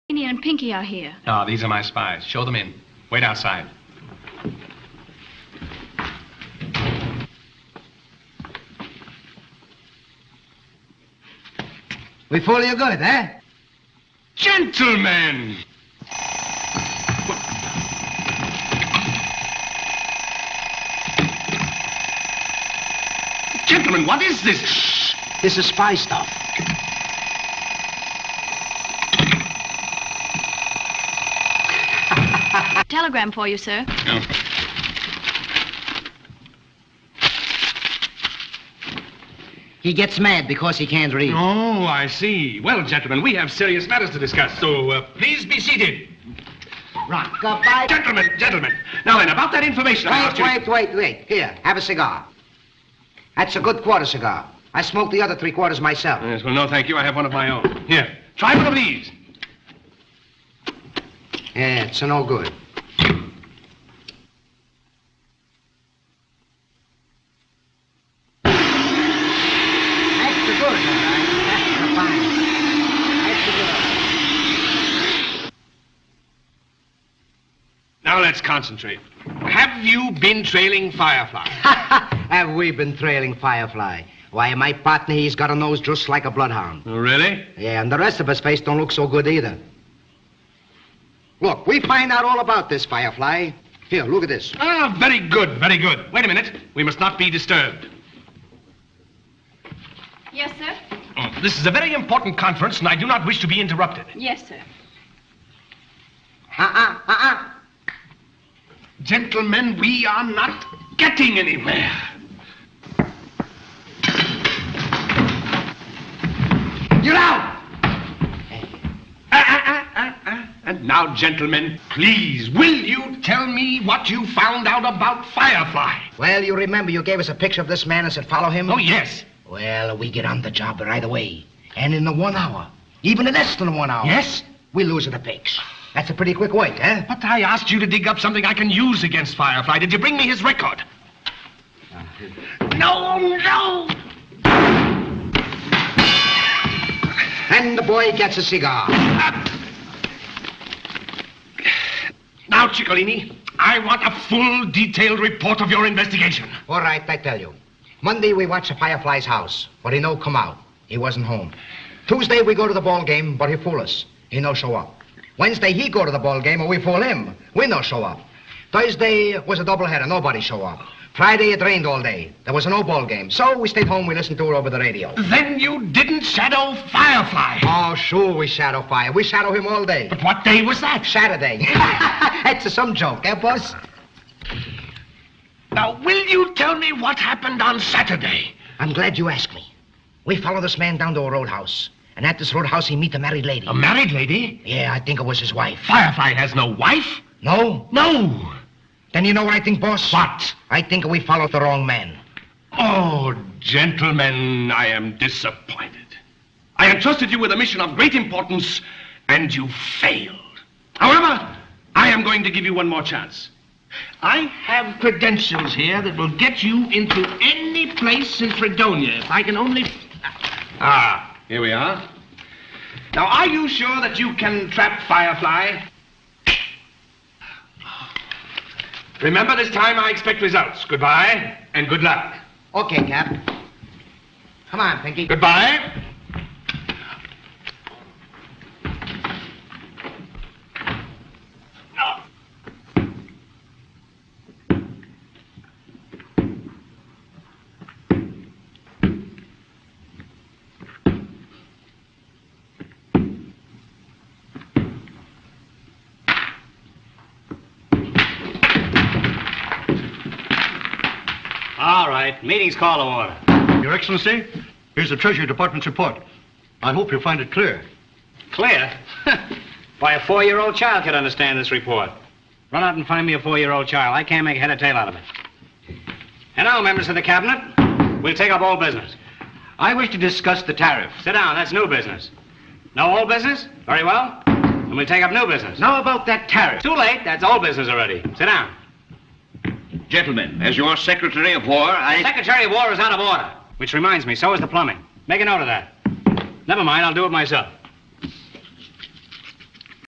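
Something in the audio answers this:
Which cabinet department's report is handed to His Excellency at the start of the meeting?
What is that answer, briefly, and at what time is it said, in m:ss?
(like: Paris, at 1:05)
Treasury Department, at 4:25.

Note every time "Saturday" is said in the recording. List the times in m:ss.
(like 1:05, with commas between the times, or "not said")
3:01, 3:07.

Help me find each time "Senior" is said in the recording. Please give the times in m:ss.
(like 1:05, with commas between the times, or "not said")
0:00.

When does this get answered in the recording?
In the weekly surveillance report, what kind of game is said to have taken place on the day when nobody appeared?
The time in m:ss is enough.
2:49.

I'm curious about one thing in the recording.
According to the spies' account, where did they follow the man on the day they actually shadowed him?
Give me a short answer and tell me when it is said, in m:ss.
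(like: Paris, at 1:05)
a roadhouse, at 3:11.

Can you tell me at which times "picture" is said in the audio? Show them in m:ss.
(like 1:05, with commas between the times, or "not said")
2:07.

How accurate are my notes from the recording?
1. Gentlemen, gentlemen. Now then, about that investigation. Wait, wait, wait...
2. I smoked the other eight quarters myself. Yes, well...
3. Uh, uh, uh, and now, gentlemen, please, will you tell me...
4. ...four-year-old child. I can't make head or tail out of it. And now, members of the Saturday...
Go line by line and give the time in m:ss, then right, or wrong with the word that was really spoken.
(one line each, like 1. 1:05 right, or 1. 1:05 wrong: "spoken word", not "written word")
1. 0:47 wrong: "information", not "investigation"
2. 0:54 wrong: "three", not "eight"
3. 1:59 right
4. 4:33 wrong: "Cabinet", not "Saturday".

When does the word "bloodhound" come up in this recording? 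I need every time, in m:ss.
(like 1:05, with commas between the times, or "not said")
1:26.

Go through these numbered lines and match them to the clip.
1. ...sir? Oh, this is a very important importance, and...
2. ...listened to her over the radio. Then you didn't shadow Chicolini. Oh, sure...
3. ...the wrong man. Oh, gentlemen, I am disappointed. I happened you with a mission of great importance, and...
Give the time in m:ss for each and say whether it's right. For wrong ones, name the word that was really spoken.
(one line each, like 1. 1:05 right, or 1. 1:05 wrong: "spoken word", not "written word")
1. 1:40 wrong: "conference", not "importance"
2. 2:54 wrong: "Firefly", not "Chicolini"
3. 3:21 wrong: "entrusted", not "happened".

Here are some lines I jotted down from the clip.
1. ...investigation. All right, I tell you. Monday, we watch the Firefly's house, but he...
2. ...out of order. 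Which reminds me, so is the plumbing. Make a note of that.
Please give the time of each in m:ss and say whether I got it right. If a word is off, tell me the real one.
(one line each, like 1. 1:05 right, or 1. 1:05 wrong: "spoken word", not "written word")
1. 2:35 right
2. 4:52 right.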